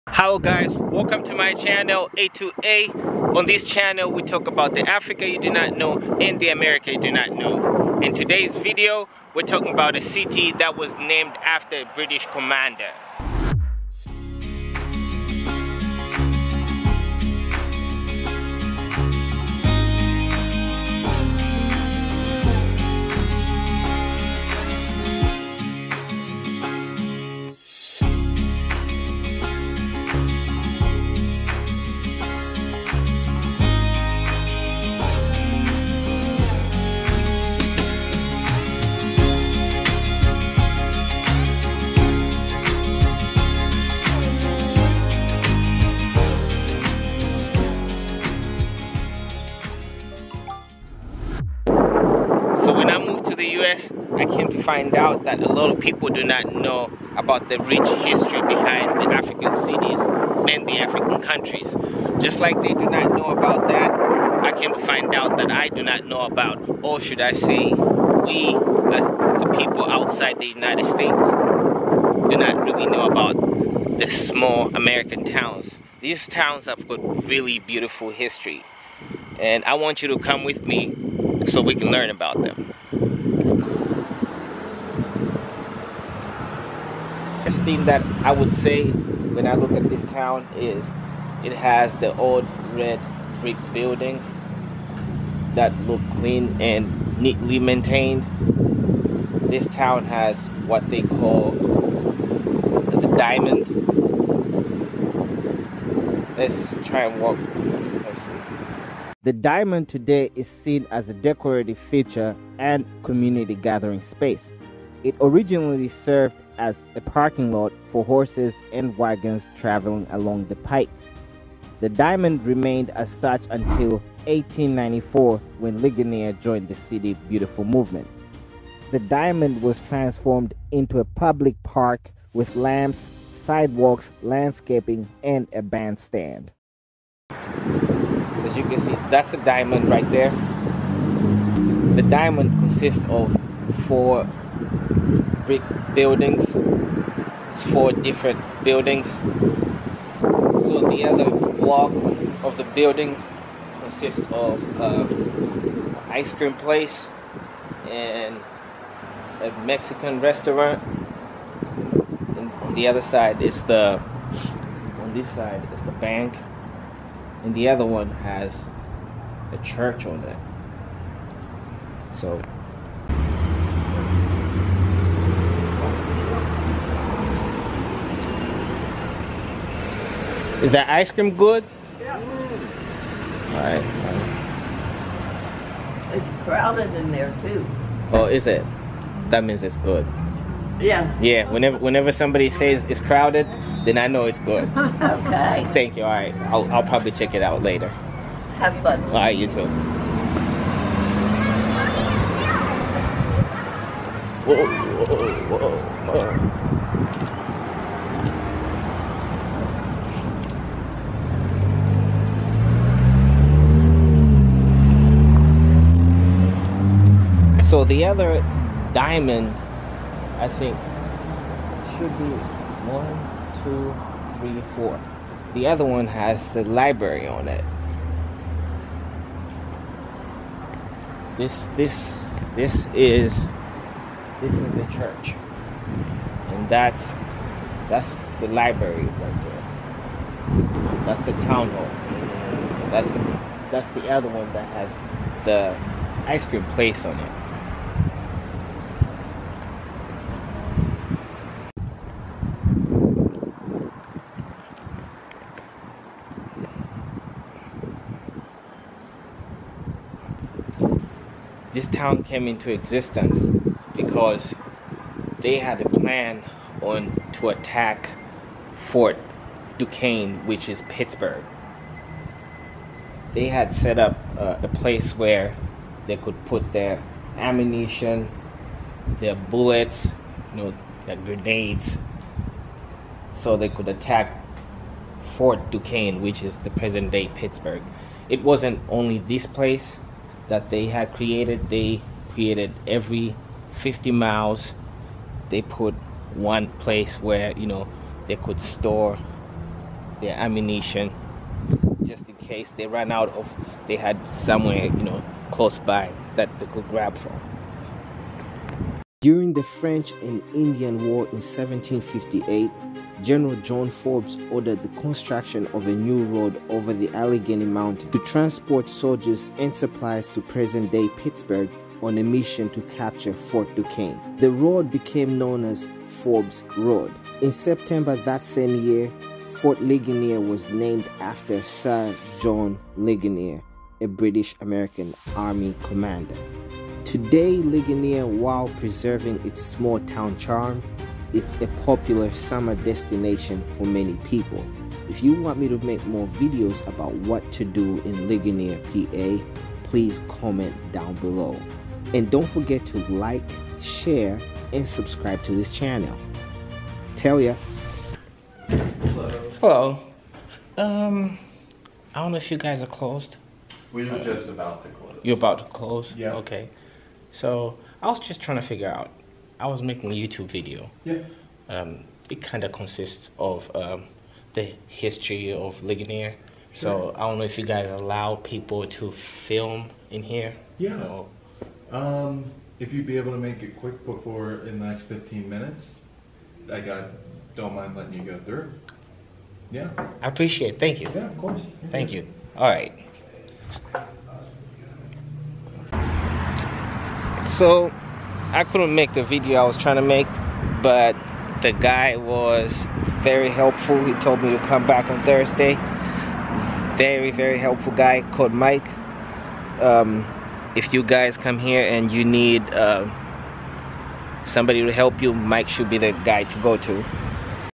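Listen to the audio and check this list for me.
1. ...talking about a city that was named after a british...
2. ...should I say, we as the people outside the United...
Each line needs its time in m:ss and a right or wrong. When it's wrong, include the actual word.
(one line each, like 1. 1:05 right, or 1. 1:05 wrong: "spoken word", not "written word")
1. 0:09 right
2. 1:07 right.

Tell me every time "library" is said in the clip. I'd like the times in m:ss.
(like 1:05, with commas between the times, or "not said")
3:46, 3:58.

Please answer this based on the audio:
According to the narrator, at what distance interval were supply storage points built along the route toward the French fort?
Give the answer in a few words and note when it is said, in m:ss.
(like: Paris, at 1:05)
Every 50 miles, at 4:52.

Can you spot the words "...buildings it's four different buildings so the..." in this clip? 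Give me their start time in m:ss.
2:25.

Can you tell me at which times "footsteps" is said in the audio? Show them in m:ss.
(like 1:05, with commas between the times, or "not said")
not said.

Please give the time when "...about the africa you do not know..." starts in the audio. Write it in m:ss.
0:04.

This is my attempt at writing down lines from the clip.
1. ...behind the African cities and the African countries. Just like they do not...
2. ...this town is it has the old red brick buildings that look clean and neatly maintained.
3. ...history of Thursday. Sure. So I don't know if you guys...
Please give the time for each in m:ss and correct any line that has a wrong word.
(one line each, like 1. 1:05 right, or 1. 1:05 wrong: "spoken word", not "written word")
1. 0:58 right
2. 1:29 right
3. 6:14 wrong: "Ligonier", not "Thursday".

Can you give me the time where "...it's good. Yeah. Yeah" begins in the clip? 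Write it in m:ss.
3:09.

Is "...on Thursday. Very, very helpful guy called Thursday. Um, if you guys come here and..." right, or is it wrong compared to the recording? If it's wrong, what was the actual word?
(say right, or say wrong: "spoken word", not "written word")
wrong: "Mike", not "Thursday".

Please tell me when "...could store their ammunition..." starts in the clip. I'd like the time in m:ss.
4:58.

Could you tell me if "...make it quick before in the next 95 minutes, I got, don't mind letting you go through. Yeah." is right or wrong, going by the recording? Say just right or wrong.
wrong.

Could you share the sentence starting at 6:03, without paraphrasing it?
We were uh, just about to close.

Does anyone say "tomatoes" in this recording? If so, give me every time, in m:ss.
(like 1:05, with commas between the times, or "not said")
not said.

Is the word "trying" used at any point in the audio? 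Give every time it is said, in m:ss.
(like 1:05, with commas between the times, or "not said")
6:08, 6:39.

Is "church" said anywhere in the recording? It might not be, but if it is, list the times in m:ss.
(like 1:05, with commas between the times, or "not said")
2:49, 3:54.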